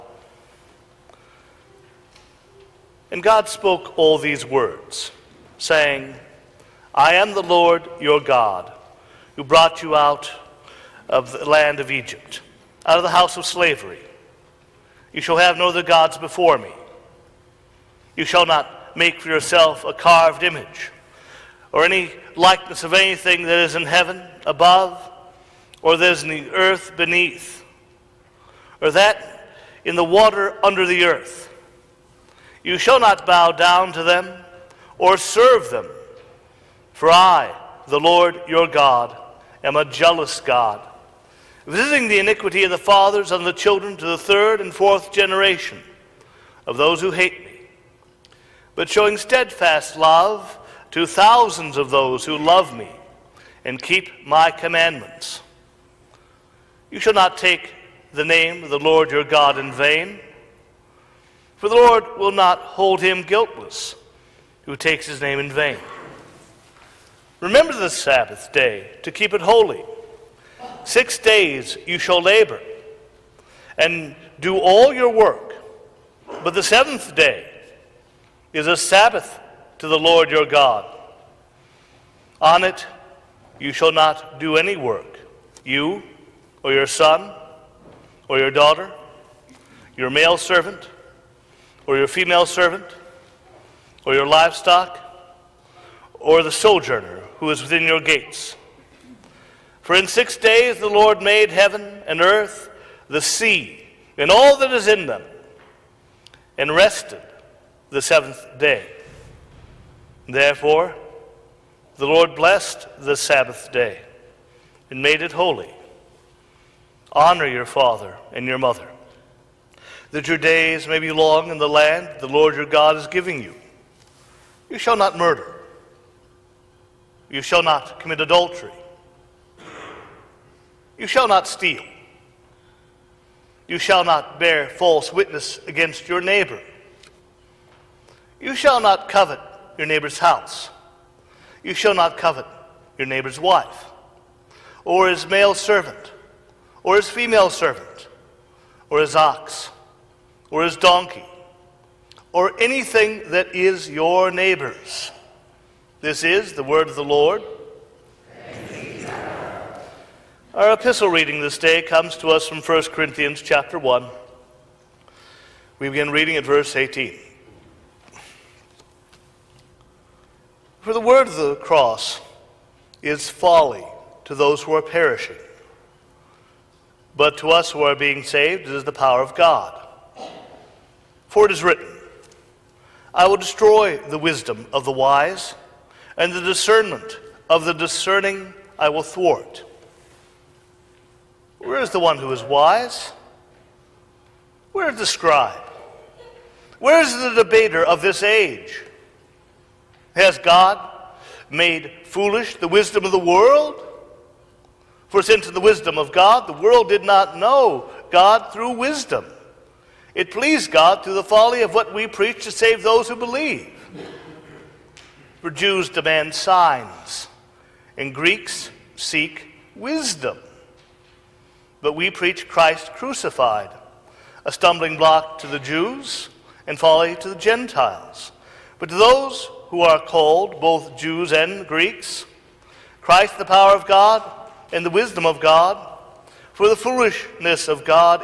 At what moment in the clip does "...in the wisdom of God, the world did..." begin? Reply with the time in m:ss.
3:25.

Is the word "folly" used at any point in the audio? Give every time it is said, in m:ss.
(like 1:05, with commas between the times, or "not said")
2:53, 3:31, 3:46.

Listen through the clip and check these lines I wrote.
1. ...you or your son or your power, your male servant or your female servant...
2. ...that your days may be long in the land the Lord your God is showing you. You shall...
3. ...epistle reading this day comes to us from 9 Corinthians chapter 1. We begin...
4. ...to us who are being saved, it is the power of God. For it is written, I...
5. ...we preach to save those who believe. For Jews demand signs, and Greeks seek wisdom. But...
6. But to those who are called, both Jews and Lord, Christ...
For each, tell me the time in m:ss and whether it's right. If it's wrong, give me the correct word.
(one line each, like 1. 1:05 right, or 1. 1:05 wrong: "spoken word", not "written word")
1. 1:25 wrong: "daughter", not "power"
2. 2:00 wrong: "giving", not "showing"
3. 2:40 wrong: "1", not "9"
4. 2:57 right
5. 3:31 right
6. 3:48 wrong: "Greeks", not "Lord".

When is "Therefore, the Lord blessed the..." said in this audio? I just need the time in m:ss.
1:50.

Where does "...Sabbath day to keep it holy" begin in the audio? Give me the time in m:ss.
1:07.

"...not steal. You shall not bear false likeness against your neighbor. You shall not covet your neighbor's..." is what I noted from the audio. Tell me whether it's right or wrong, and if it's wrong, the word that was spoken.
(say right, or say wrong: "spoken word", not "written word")
wrong: "witness", not "likeness".